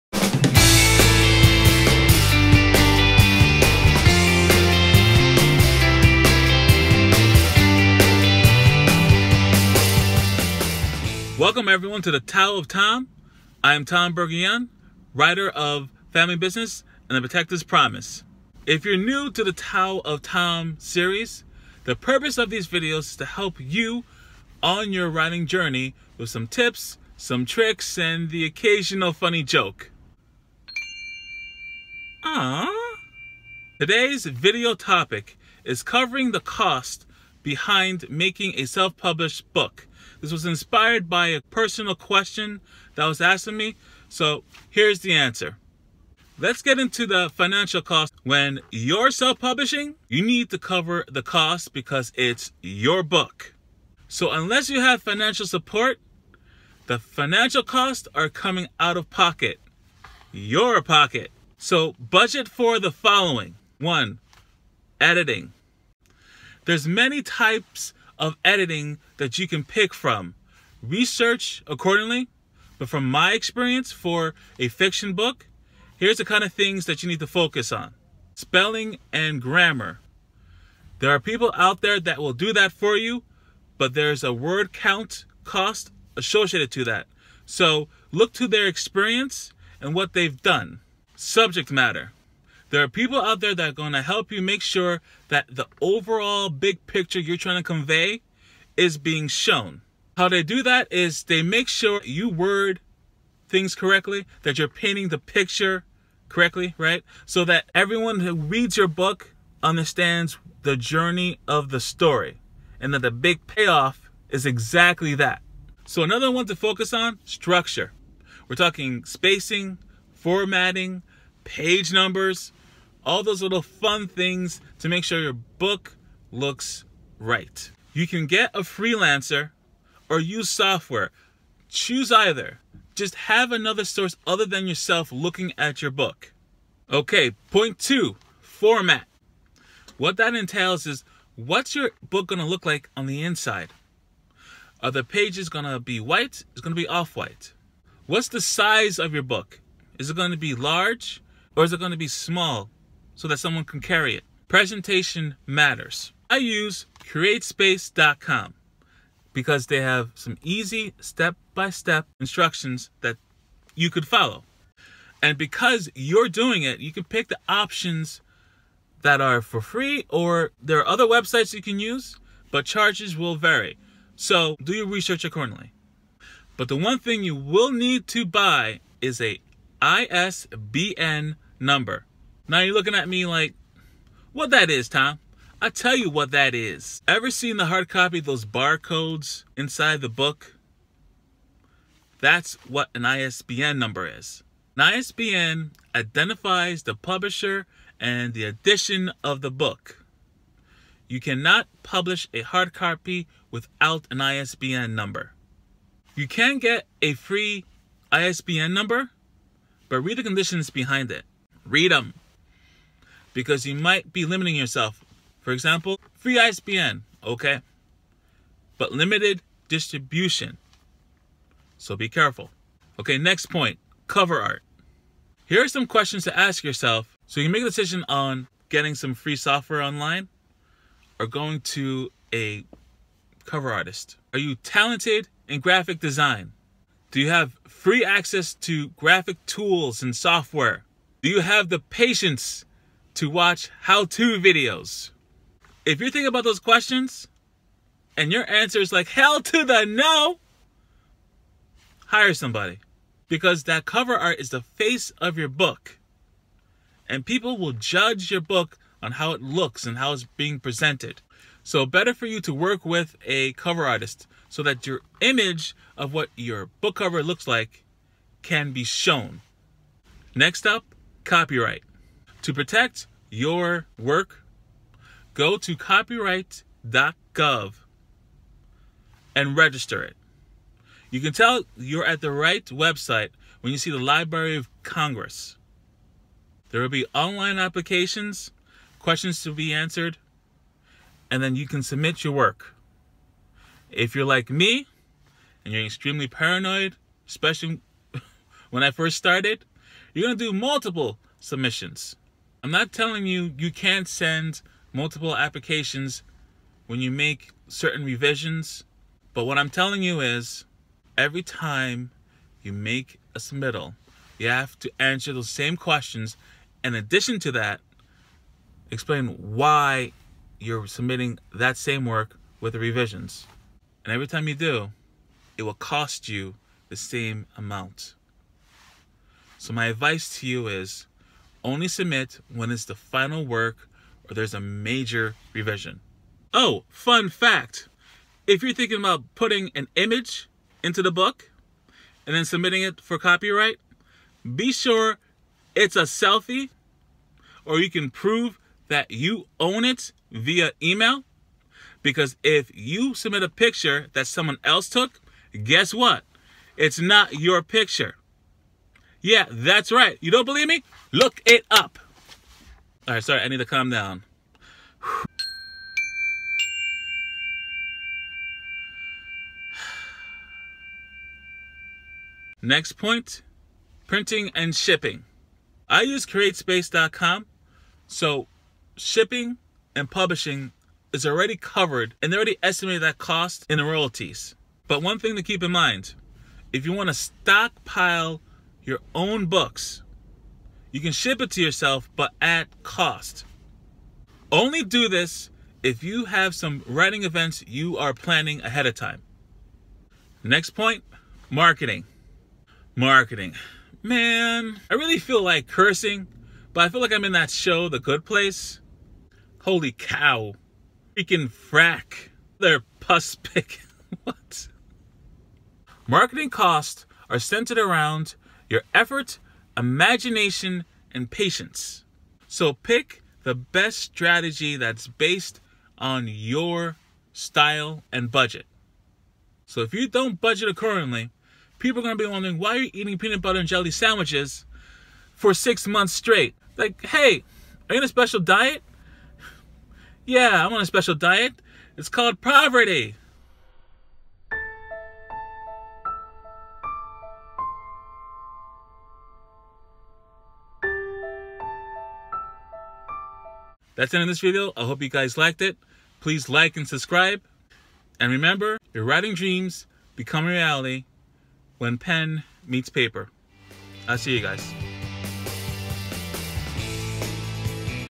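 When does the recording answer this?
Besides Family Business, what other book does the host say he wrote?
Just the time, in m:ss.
0:17.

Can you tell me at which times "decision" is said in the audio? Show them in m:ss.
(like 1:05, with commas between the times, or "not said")
3:47.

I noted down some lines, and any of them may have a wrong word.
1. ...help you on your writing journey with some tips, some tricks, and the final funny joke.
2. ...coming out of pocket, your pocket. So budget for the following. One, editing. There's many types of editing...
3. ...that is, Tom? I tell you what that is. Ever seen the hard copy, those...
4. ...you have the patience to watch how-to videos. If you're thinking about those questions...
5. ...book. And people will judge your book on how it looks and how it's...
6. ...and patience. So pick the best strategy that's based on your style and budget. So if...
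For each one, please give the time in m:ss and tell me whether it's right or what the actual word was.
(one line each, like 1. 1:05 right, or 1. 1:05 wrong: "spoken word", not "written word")
1. 0:23 wrong: "occasional", not "final"
2. 0:58 right
3. 3:04 right
4. 4:01 right
5. 4:15 right
6. 7:01 right.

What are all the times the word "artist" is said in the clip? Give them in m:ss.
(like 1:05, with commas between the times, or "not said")
3:53, 4:23.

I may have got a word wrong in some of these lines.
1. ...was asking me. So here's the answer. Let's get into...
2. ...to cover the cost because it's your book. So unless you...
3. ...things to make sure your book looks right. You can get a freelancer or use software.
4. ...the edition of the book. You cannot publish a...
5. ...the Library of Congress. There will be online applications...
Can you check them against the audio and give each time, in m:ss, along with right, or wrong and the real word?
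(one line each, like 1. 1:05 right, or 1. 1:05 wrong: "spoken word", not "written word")
1. 0:43 right
2. 0:50 right
3. 2:04 right
4. 3:18 right
5. 4:43 right.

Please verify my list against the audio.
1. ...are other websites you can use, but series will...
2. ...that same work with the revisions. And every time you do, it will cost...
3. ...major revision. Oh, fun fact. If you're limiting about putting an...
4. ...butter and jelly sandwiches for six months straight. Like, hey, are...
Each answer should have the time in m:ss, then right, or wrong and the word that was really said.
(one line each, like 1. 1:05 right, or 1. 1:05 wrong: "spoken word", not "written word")
1. 2:50 wrong: "charges", not "series"
2. 5:21 right
3. 5:34 wrong: "thinking", not "limiting"
4. 7:13 right.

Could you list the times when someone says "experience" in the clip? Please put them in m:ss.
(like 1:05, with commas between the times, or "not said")
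1:13, 1:28.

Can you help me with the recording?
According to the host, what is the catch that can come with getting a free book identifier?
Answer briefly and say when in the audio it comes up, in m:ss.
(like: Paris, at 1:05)
Limited distribution, at 3:38.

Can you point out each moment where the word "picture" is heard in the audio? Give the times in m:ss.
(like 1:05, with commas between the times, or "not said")
1:36, 1:45, 5:53, 5:57.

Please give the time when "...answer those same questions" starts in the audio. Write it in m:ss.
5:14.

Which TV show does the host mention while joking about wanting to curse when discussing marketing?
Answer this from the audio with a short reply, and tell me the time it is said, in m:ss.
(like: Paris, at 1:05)
The Good Place, at 6:47.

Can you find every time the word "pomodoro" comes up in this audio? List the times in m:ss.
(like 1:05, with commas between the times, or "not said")
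not said.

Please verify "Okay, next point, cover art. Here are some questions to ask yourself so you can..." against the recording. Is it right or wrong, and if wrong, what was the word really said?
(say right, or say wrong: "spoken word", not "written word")
right.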